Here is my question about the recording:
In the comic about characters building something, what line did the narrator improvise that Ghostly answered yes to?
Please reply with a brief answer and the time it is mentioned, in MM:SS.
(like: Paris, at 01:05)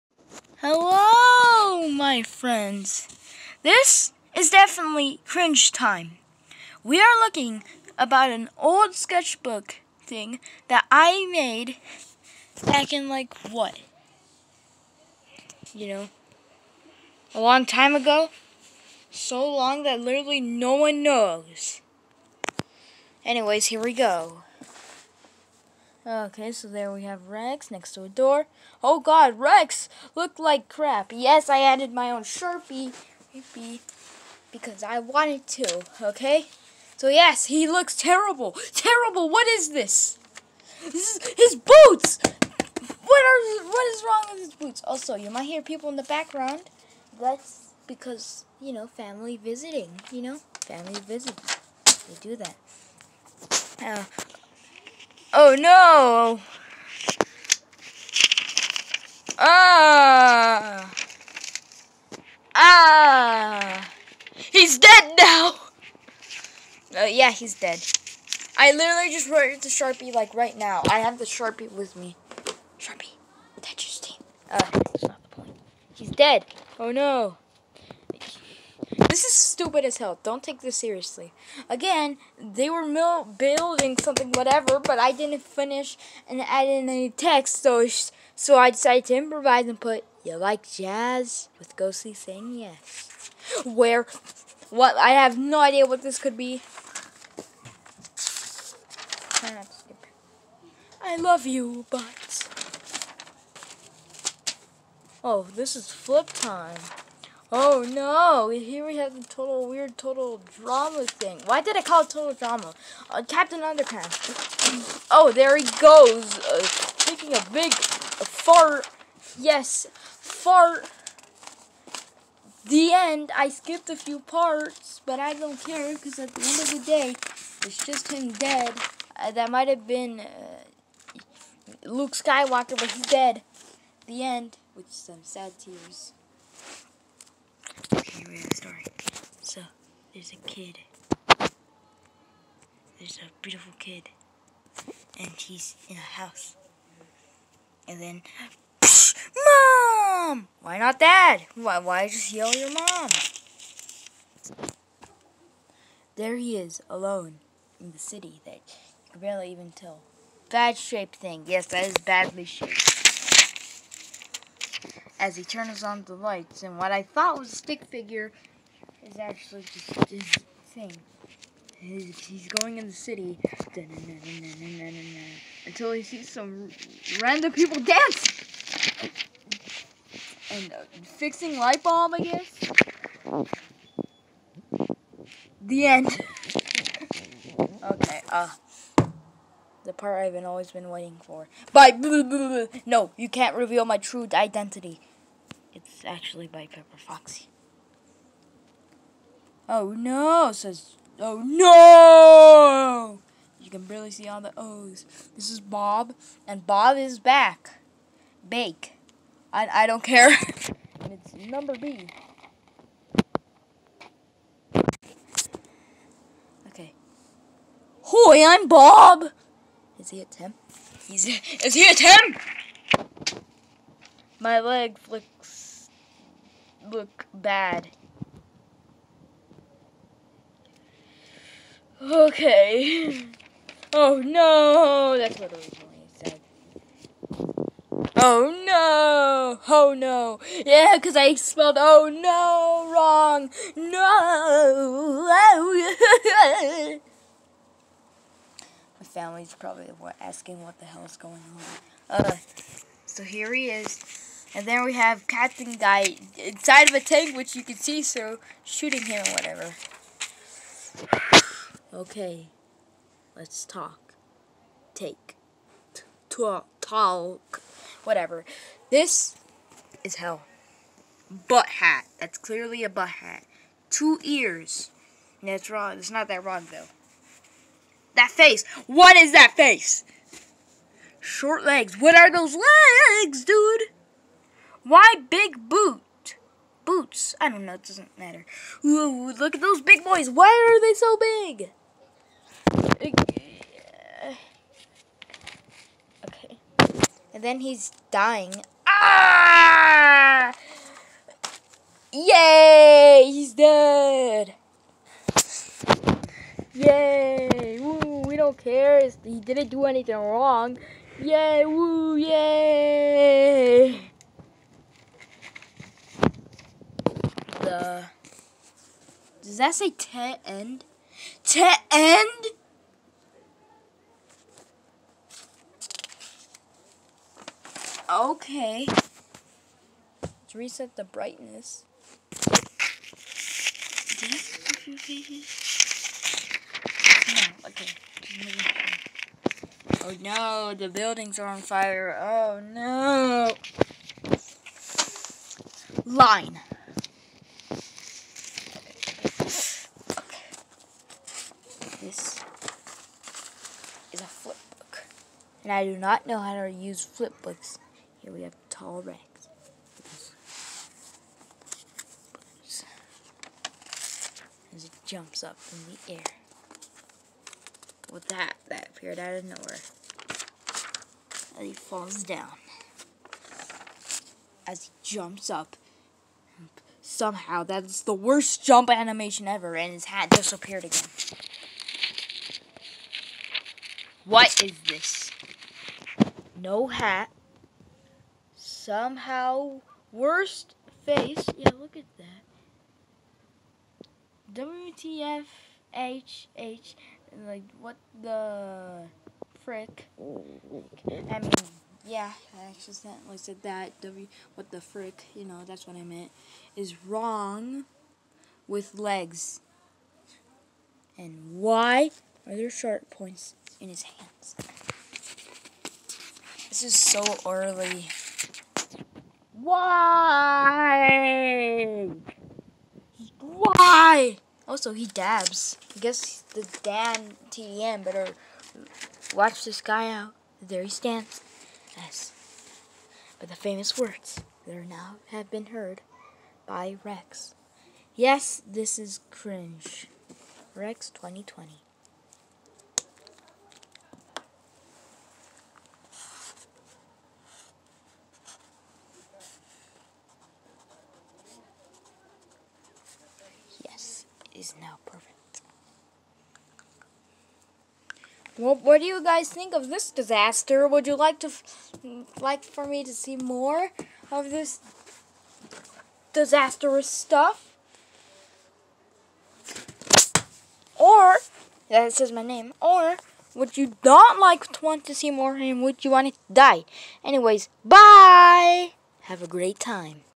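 You like jazz?, at 01:30.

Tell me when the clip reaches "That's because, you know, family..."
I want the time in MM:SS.
00:47.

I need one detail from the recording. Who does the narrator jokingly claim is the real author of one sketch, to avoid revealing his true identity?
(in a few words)
Pepper Foxy.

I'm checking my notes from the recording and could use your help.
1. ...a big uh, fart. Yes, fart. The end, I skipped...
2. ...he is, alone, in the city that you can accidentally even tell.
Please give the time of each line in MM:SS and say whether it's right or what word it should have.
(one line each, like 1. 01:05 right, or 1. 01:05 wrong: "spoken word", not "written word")
1. 01:57 right
2. 02:36 wrong: "barely", not "accidentally".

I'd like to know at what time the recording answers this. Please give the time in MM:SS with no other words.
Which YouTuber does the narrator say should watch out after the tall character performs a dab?
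07:06.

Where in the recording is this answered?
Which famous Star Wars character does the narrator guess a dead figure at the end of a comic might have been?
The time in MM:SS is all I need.
02:11.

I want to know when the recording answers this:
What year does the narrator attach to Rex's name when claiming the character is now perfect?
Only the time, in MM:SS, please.
07:21.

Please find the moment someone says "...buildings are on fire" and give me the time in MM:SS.
05:40.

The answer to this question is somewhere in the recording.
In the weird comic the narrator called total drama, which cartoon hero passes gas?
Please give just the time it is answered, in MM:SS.
01:53.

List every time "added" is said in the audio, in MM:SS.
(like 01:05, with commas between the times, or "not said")
00:31.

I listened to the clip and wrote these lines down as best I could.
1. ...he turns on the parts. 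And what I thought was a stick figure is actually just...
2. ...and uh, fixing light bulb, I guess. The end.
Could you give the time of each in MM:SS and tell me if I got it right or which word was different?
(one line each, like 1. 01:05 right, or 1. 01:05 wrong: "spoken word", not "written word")
1. 02:45 wrong: "lights", not "parts"
2. 03:00 right.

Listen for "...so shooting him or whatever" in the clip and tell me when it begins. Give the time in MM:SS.
04:18.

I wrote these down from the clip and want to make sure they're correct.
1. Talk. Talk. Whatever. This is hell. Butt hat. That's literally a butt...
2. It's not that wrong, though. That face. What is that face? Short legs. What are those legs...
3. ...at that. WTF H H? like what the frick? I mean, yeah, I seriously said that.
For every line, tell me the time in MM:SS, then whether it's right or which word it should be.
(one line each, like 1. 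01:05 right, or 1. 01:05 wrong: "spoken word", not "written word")
1. 04:26 wrong: "clearly", not "literally"
2. 04:35 right
3. 06:31 wrong: "accidentally", not "seriously".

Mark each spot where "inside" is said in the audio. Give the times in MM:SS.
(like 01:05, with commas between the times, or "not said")
04:16.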